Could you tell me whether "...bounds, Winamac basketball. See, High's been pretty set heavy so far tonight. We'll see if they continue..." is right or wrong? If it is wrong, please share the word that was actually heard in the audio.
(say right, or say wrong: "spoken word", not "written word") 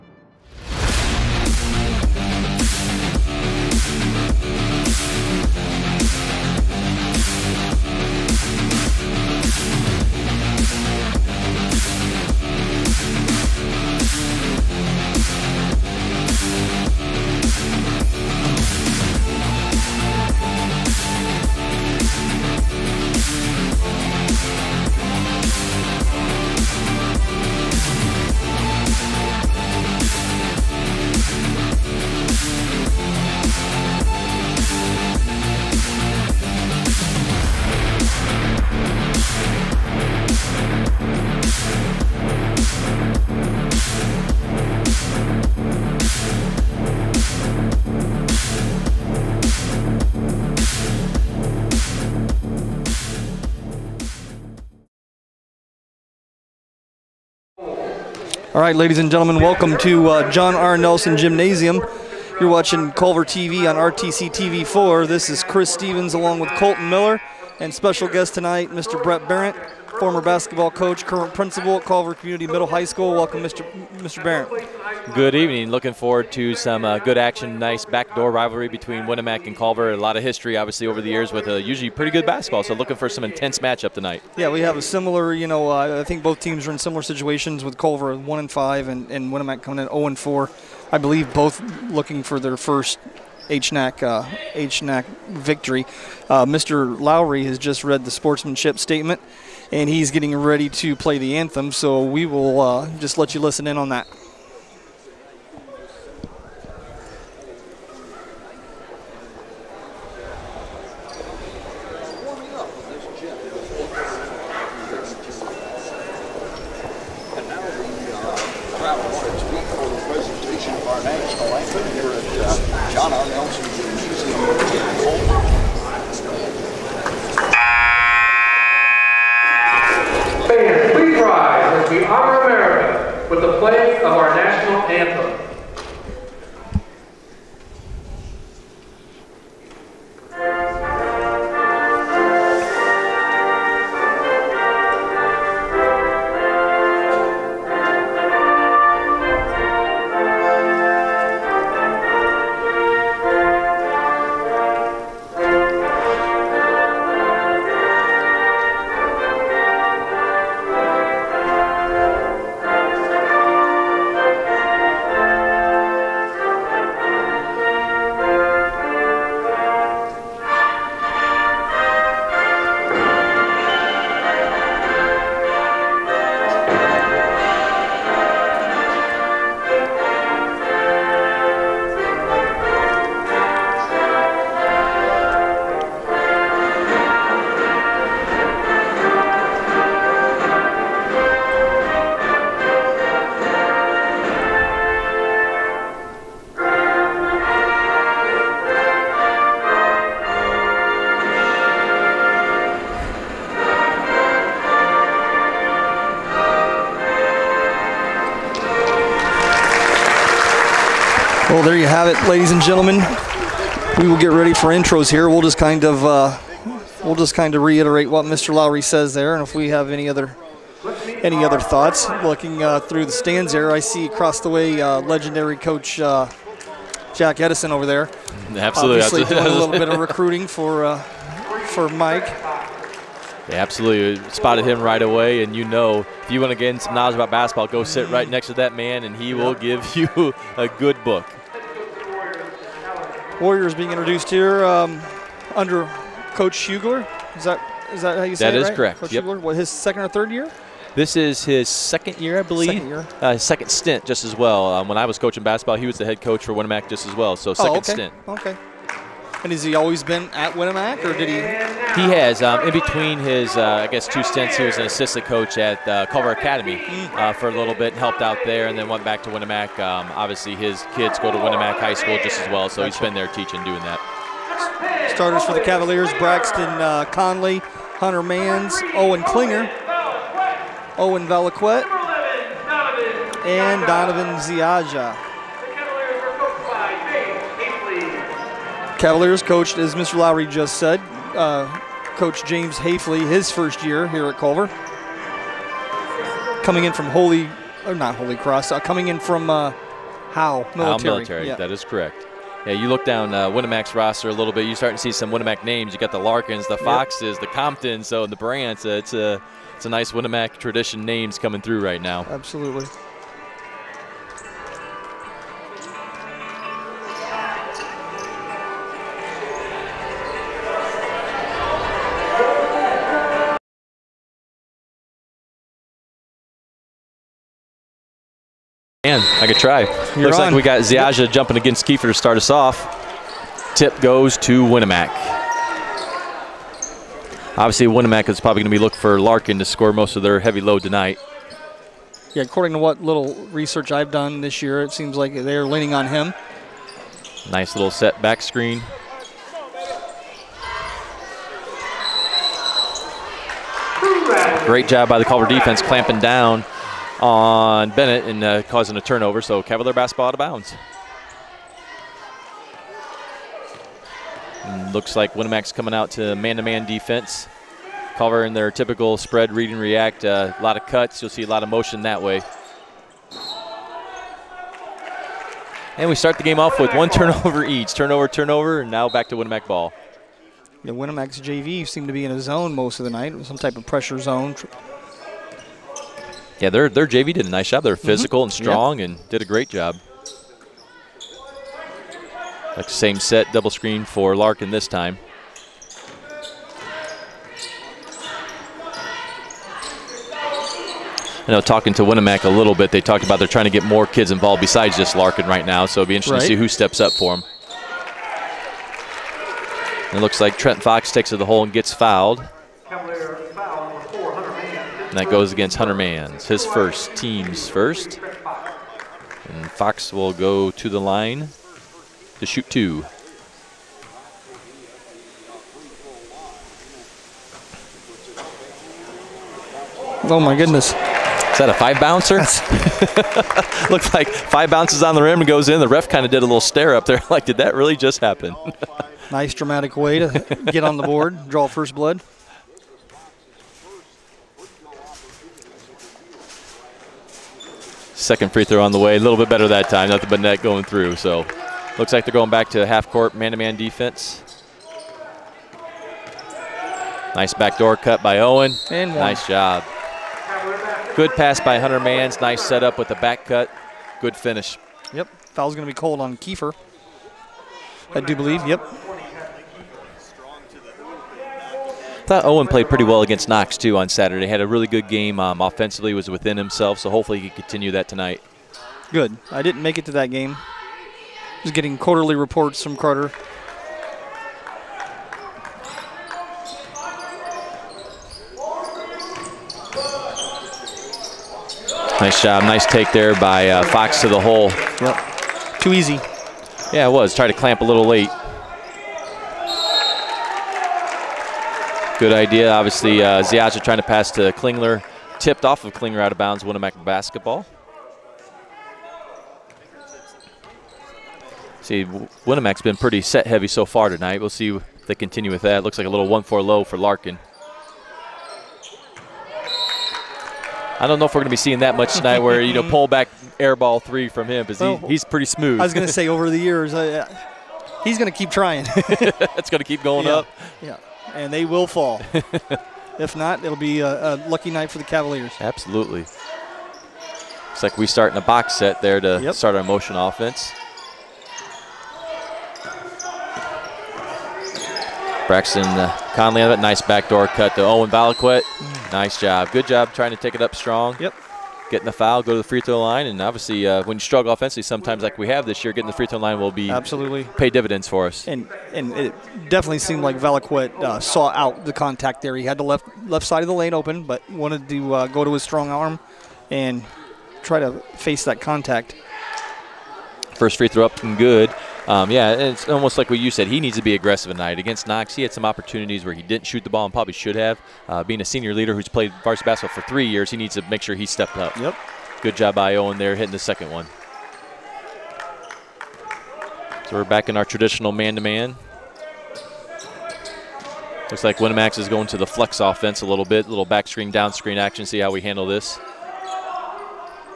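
wrong: "Winamac", not "High".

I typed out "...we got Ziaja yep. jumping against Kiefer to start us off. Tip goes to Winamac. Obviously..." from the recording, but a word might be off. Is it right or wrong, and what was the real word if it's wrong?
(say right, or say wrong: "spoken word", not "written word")
right.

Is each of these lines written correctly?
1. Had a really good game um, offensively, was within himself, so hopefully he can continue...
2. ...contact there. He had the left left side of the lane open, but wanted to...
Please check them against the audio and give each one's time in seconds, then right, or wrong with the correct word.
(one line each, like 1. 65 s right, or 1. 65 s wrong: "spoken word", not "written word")
1. 474 s right
2. 561 s right.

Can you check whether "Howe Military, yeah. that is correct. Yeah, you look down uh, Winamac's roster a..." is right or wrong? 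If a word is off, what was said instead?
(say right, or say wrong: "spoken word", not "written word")
right.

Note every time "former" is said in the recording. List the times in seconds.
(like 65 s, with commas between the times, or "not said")
69 s.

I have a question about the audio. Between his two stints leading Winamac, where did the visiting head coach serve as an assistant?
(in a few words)
Culver Academy.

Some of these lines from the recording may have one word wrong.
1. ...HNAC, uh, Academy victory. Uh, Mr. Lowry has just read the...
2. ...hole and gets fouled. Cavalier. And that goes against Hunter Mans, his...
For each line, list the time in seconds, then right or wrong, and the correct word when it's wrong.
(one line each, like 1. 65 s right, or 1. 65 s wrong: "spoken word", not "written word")
1. 93 s wrong: "HNAC", not "Academy"
2. 411 s right.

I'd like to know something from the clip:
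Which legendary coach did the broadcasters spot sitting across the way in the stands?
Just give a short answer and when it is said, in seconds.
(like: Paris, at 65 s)
Jack Edison, at 227 s.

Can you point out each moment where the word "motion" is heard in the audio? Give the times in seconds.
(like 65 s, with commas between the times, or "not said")
371 s, 539 s.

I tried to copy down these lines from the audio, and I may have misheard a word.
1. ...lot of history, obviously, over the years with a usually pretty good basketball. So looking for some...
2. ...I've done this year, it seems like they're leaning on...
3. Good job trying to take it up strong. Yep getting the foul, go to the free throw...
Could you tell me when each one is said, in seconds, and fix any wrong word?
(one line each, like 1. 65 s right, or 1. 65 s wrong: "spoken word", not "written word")
1. 79 s right
2. 343 s right
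3. 549 s right.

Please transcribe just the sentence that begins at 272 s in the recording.
he's been there teaching, doing that.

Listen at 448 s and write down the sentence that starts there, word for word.
Second free throw on the way.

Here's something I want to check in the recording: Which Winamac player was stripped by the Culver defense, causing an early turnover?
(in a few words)
Bennett.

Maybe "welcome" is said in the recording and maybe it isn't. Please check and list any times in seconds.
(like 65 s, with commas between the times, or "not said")
59 s, 73 s.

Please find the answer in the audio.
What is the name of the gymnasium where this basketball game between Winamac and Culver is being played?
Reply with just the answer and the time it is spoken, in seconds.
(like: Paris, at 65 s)
John R. Nelson Gymnasium, at 60 s.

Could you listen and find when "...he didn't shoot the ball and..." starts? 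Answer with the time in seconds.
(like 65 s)
576 s.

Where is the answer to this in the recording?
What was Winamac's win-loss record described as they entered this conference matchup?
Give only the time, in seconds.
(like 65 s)
89 s.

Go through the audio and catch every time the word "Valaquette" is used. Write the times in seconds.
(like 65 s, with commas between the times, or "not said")
548 s, 560 s.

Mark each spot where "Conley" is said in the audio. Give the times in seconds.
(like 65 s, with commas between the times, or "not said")
277 s, 546 s.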